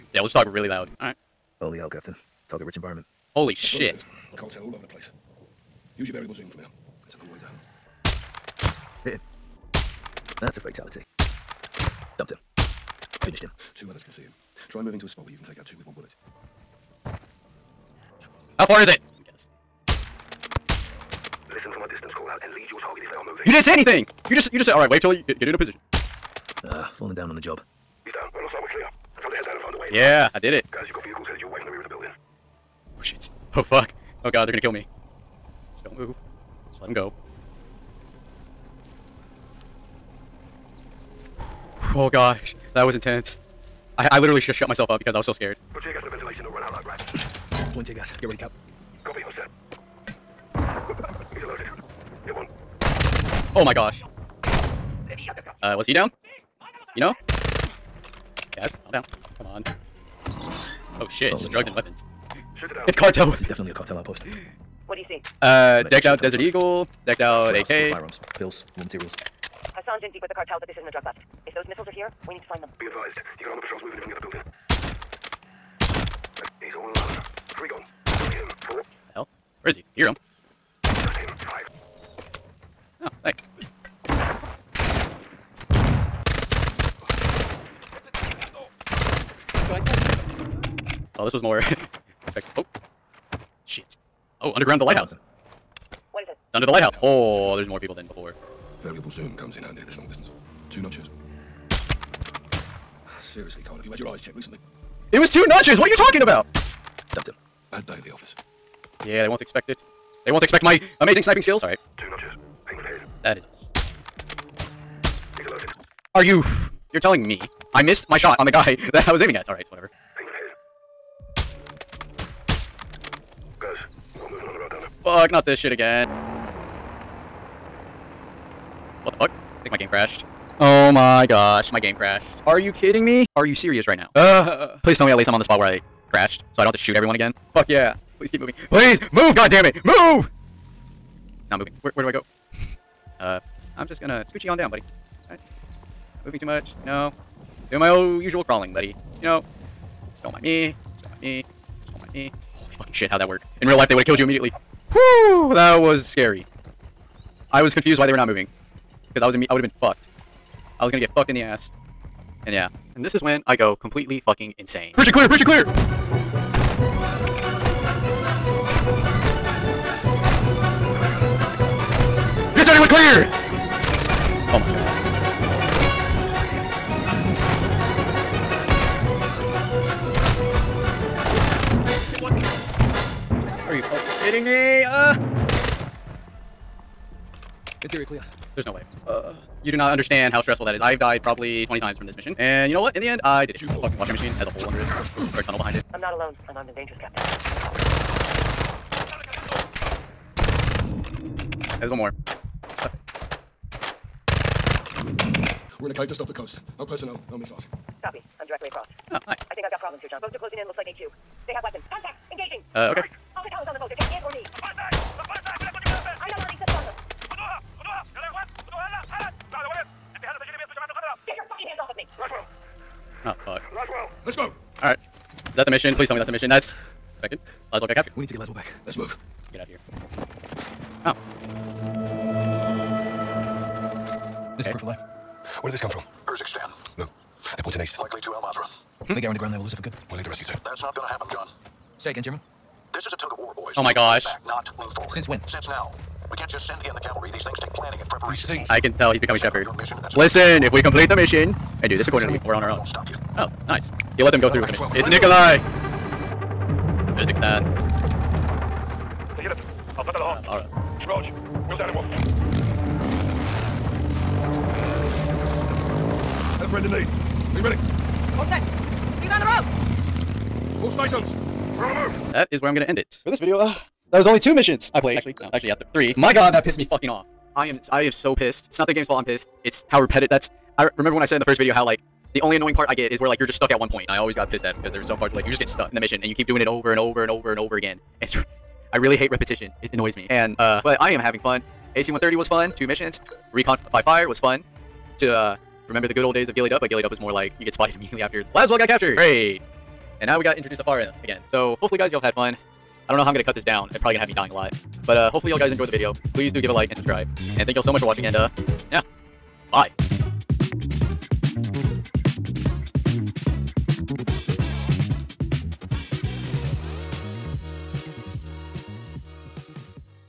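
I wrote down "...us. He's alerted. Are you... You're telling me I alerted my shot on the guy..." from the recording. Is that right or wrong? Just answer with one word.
wrong.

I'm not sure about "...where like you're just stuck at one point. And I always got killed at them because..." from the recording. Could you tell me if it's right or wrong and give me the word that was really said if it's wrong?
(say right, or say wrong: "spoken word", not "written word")
wrong: "pissed", not "killed".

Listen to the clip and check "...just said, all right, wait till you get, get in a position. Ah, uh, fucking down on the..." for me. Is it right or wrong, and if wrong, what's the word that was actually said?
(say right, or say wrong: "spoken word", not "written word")
wrong: "falling", not "fucking".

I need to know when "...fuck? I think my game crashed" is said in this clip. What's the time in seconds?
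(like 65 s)
129 s.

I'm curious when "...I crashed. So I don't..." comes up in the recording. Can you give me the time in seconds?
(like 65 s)
135 s.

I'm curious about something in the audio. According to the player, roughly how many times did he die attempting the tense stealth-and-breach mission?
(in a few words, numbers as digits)
20.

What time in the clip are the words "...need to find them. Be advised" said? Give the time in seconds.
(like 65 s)
72 s.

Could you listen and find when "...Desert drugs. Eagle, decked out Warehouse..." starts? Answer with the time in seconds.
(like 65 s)
66 s.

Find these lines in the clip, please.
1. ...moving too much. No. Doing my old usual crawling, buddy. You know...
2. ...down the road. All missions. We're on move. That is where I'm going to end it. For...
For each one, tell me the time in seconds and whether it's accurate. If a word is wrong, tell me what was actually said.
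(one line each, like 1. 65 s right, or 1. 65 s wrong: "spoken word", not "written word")
1. 146 s right
2. 269 s wrong: "stations", not "missions".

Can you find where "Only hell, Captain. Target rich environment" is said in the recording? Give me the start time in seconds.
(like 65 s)
1 s.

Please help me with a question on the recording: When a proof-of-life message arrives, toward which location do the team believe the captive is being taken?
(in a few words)
Al Mazrah.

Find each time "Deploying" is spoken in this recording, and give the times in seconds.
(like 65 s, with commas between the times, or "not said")
47 s.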